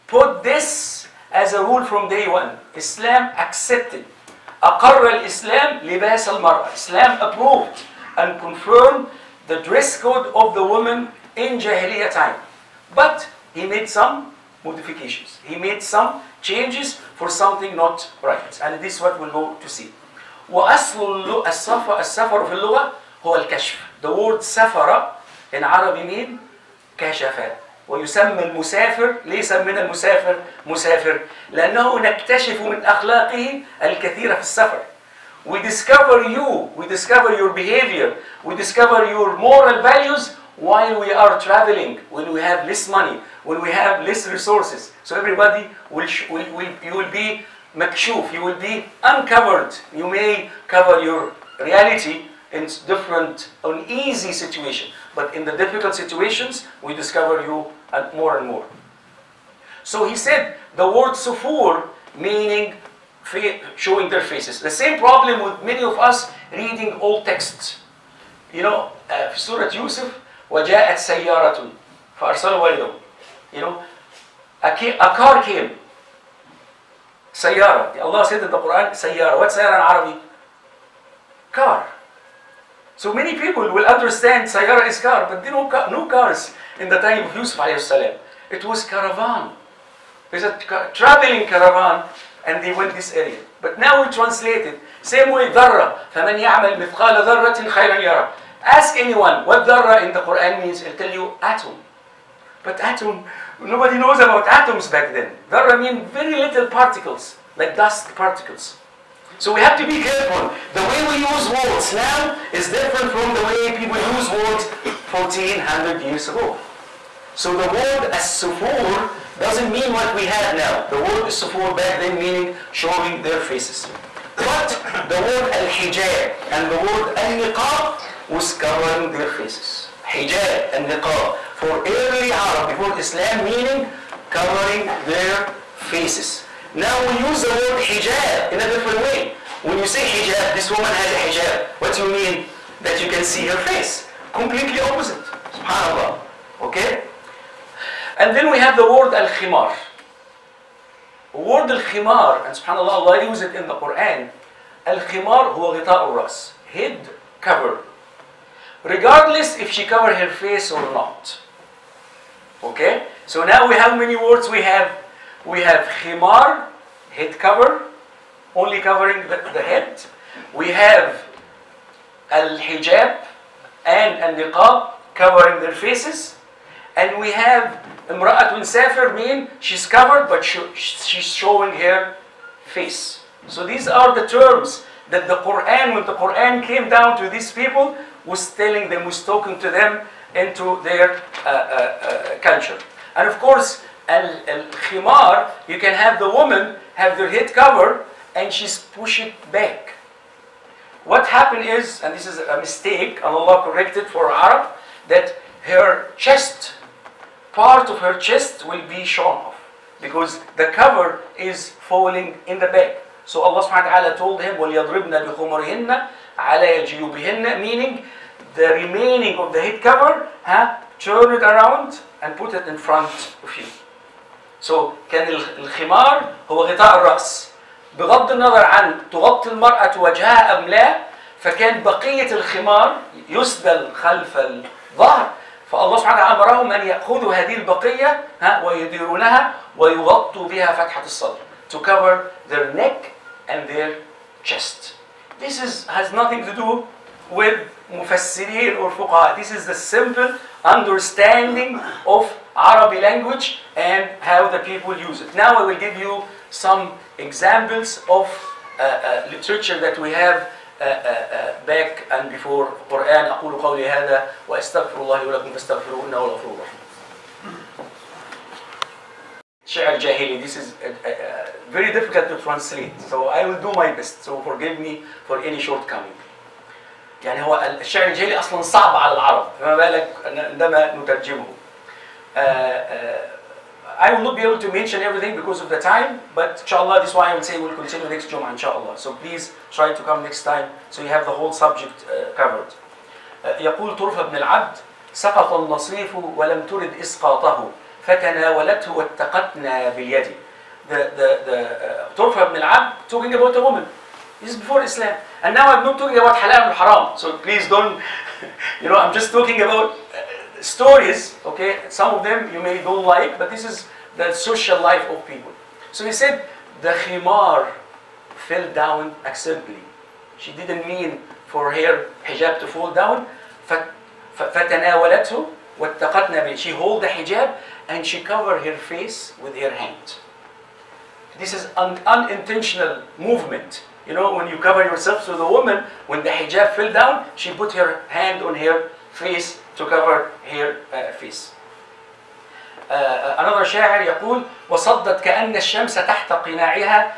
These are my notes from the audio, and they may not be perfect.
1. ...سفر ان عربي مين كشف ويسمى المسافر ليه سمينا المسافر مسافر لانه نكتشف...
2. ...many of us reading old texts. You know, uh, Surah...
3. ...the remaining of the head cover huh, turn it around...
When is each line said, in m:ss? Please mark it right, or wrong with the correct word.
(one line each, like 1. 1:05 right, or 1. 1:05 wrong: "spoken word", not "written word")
1. 0:24 right
2. 1:05 right
3. 3:38 right.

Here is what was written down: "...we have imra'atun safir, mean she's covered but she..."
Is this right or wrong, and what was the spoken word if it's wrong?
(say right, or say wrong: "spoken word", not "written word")
right.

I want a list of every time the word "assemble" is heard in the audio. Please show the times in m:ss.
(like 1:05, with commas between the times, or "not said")
not said.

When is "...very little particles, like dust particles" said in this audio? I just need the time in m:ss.
1:46.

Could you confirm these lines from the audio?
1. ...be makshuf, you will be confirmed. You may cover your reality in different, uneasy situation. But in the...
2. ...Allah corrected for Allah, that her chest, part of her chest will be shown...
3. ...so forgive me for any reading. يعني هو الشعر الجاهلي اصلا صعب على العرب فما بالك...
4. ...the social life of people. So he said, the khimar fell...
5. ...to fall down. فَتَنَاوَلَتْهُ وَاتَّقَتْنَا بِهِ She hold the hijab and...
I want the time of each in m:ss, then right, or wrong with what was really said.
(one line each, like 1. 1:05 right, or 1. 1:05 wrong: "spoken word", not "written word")
1. 0:47 wrong: "uncovered", not "confirmed"
2. 3:23 wrong: "Arab", not "Allah"
3. 4:34 wrong: "shortcoming", not "reading"
4. 5:14 right
5. 5:22 right.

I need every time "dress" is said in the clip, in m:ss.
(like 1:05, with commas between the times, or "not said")
0:09.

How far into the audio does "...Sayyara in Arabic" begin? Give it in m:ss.
1:19.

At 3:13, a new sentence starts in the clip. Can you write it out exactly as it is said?
And of course, al-khimar, you can have the woman have their head covered and she's pushed back.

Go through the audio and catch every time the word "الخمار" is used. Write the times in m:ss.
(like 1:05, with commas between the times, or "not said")
3:45, 3:52.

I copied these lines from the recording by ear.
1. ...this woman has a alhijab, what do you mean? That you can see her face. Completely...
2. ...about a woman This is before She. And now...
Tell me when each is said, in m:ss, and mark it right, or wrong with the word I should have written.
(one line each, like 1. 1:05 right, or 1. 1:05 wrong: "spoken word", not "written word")
1. 2:20 wrong: "hijab", not "alhijab"
2. 5:03 wrong: "Islam", not "She".